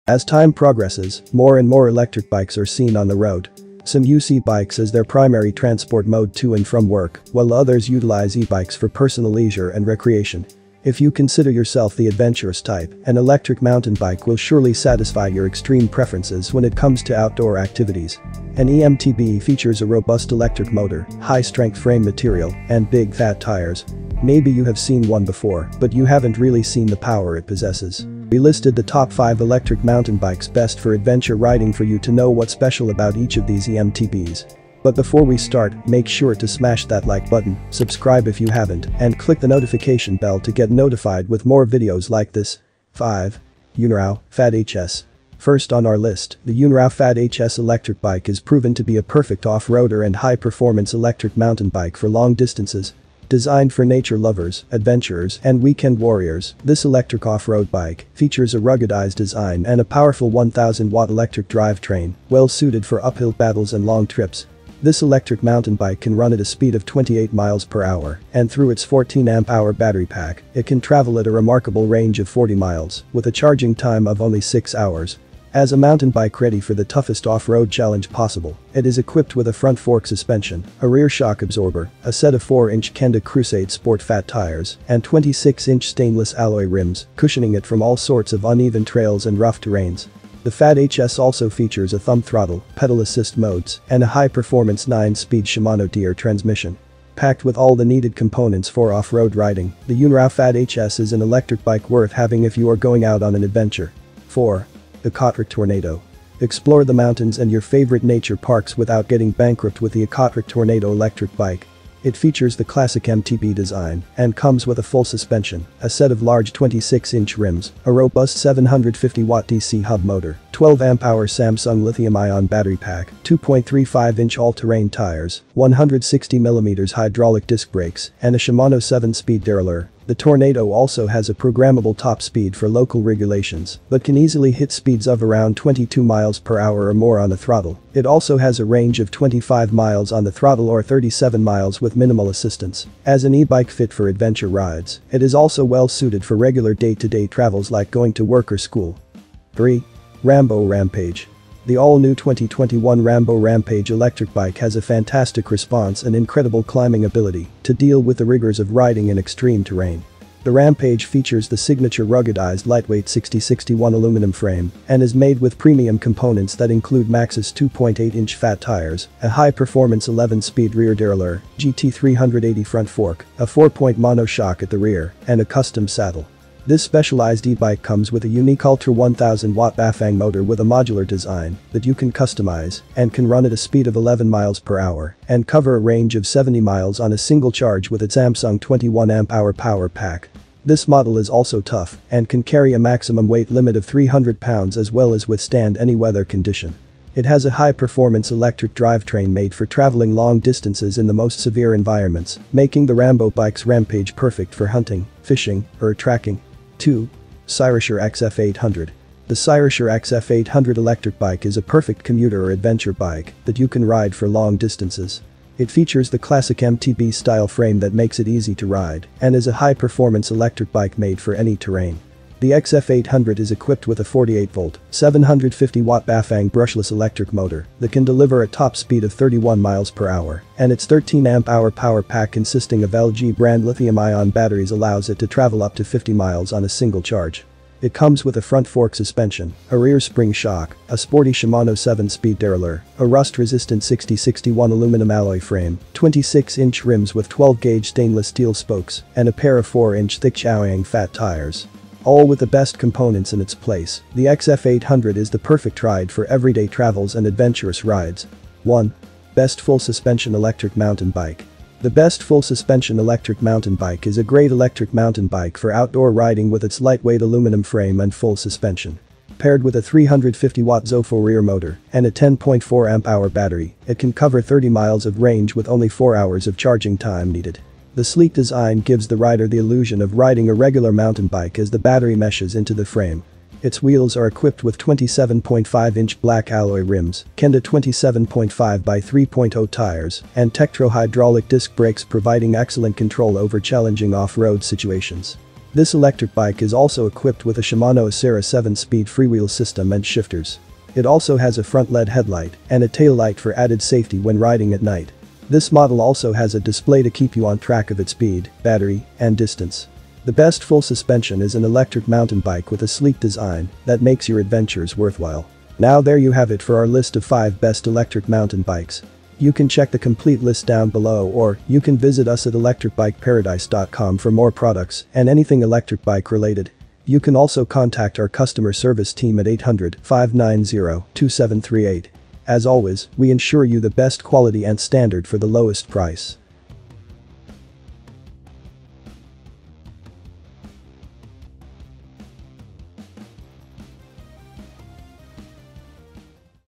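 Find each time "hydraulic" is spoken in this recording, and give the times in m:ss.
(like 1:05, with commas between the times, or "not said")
2:06, 4:50.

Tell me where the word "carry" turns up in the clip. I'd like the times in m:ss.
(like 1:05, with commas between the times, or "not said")
3:12.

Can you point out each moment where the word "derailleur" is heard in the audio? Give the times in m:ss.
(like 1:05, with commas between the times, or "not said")
2:09, 2:50, 4:02.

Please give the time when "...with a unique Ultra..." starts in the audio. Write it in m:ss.
2:58.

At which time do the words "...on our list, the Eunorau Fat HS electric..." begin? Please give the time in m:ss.
0:45.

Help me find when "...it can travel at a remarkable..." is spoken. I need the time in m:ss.
1:10.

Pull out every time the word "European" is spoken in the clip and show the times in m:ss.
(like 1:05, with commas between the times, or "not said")
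not said.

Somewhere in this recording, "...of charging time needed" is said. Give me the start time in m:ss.
4:36.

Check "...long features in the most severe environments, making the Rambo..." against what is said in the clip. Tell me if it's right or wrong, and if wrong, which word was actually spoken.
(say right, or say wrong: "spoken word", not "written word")
wrong: "distances", not "features".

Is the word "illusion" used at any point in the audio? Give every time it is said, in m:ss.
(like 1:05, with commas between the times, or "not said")
4:39.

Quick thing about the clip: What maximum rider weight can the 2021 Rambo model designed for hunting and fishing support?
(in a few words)
300 pounds.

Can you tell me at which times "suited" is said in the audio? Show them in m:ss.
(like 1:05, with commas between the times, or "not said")
1:02, 2:25.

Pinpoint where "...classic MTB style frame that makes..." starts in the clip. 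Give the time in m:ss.
3:36.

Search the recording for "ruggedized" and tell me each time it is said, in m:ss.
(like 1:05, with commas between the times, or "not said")
0:58, 2:42.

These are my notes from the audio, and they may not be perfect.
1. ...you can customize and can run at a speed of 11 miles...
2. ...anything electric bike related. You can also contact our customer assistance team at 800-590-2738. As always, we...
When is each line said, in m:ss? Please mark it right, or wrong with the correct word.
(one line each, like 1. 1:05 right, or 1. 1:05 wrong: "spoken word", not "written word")
1. 3:01 right
2. 5:25 wrong: "service", not "assistance".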